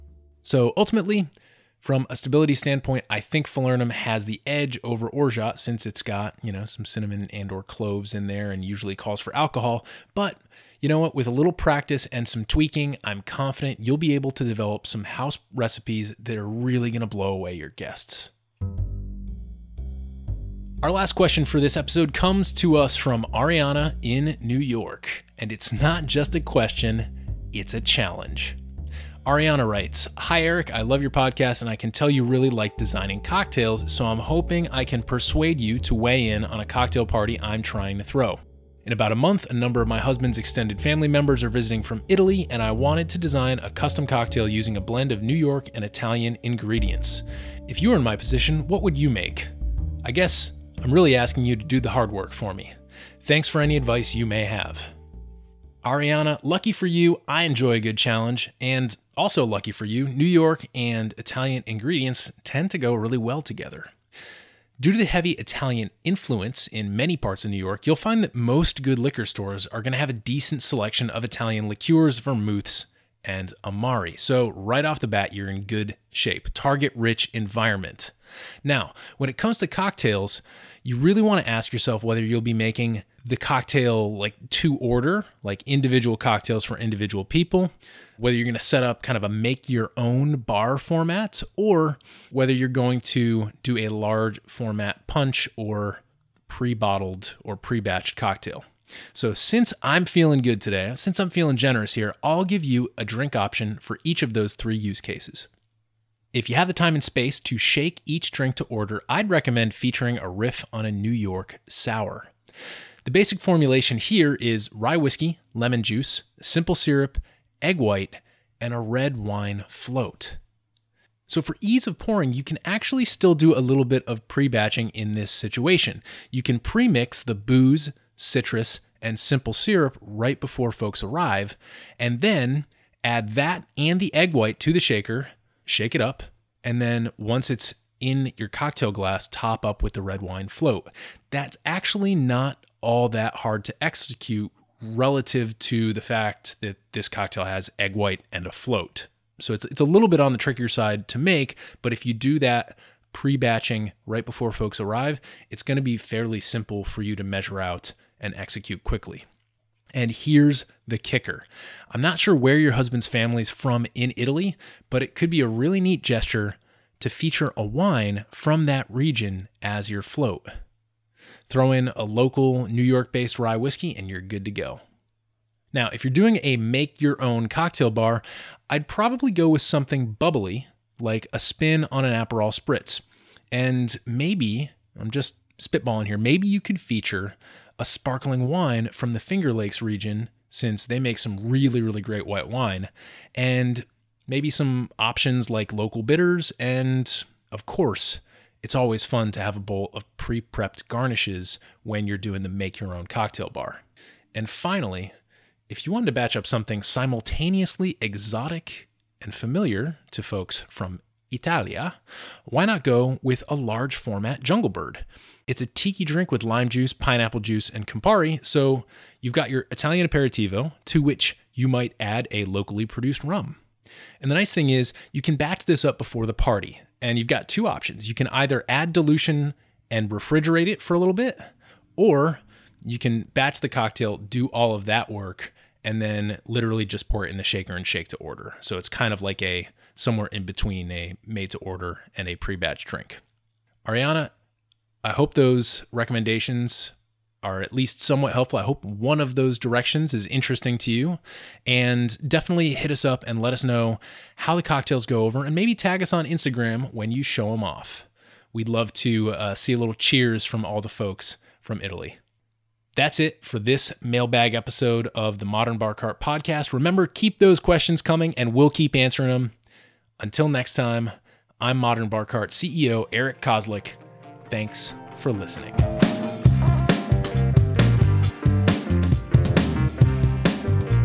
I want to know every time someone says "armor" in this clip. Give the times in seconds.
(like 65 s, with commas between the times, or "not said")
not said.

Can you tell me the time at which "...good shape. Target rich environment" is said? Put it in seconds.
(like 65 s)
75 s.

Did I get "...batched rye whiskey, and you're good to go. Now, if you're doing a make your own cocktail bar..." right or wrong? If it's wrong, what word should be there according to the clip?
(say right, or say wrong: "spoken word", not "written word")
wrong: "based", not "batched".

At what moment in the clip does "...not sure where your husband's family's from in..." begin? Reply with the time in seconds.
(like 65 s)
162 s.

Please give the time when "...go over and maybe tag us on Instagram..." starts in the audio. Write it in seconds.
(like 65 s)
255 s.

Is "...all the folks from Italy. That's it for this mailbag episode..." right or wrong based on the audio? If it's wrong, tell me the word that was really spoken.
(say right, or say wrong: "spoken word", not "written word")
right.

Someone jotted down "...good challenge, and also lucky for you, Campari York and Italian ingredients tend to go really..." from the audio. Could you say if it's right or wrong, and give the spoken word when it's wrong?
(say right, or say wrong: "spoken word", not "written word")
wrong: "New", not "Campari".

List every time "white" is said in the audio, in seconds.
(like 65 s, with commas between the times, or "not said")
117 s, 134 s, 147 s, 192 s.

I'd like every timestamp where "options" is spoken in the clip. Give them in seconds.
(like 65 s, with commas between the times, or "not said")
103 s, 195 s, 227 s.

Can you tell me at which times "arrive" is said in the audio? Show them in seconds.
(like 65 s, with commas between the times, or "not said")
131 s, 154 s.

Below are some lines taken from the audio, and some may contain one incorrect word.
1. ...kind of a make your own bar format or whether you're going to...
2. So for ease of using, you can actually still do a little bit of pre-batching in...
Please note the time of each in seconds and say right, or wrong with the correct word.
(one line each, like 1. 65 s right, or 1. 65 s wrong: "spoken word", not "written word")
1. 89 s right
2. 121 s wrong: "pouring", not "using".